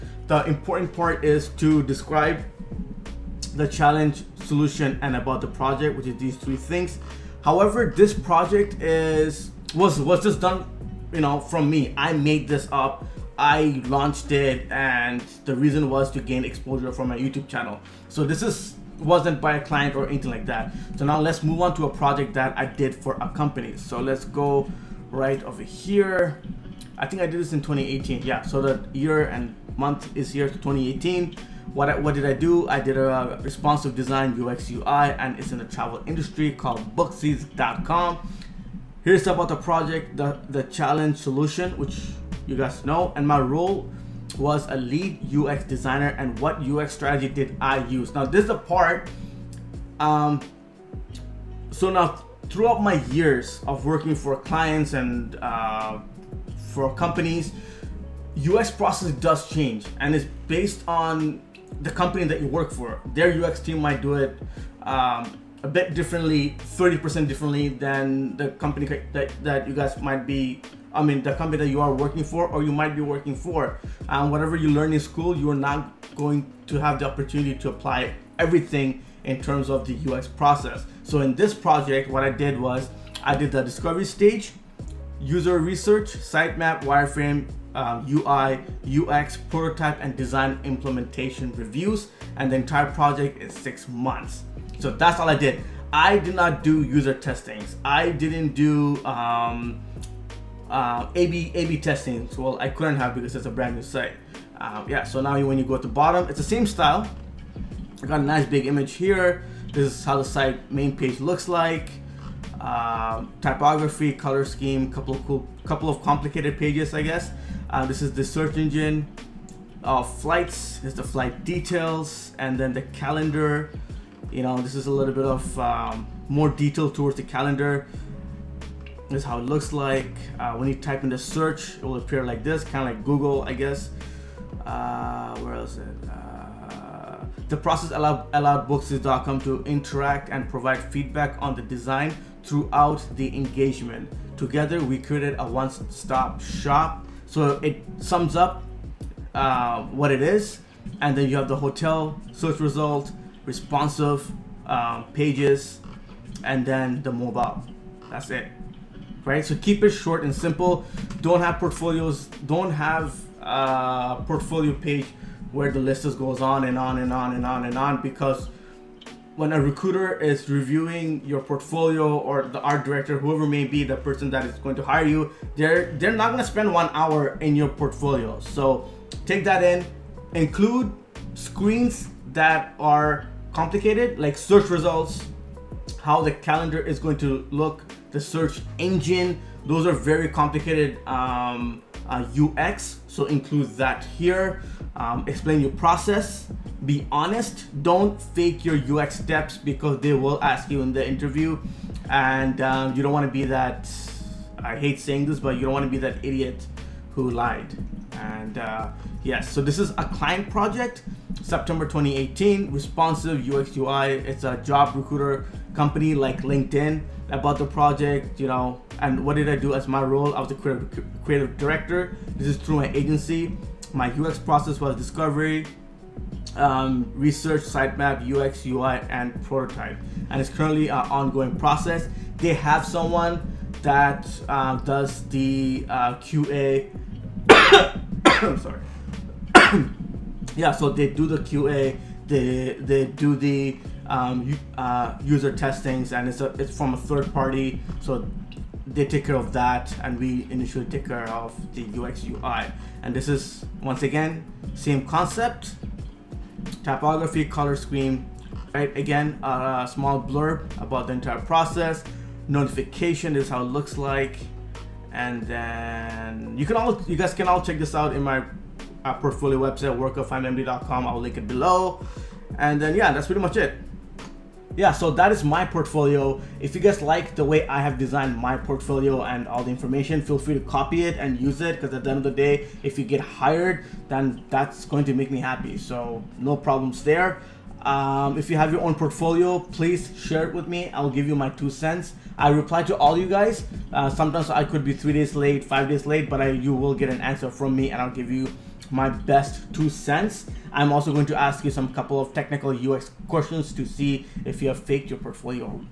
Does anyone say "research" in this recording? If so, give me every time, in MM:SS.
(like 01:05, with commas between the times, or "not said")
01:25, 03:47.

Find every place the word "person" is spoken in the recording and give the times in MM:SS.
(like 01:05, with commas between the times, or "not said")
02:53.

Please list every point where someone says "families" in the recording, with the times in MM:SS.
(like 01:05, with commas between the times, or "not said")
not said.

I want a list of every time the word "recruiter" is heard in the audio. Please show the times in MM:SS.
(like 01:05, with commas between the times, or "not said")
02:49, 03:34.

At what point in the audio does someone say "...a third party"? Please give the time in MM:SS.
04:06.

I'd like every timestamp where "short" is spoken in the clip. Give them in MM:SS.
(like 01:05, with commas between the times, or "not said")
02:39.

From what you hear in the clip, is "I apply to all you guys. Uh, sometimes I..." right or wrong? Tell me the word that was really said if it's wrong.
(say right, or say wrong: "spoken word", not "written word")
wrong: "reply", not "apply".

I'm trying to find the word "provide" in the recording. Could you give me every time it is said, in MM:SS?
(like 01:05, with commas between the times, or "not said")
02:20.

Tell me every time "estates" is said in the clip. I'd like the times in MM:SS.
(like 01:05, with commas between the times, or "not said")
not said.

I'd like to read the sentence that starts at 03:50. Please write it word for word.
And it's currently an ongoing process.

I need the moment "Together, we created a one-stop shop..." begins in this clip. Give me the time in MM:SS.
02:24.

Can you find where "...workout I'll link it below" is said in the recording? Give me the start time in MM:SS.
04:29.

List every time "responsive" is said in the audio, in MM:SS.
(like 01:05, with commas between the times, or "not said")
00:33, 02:33, 03:32.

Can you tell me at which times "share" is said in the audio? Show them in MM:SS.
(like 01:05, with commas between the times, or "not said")
04:50.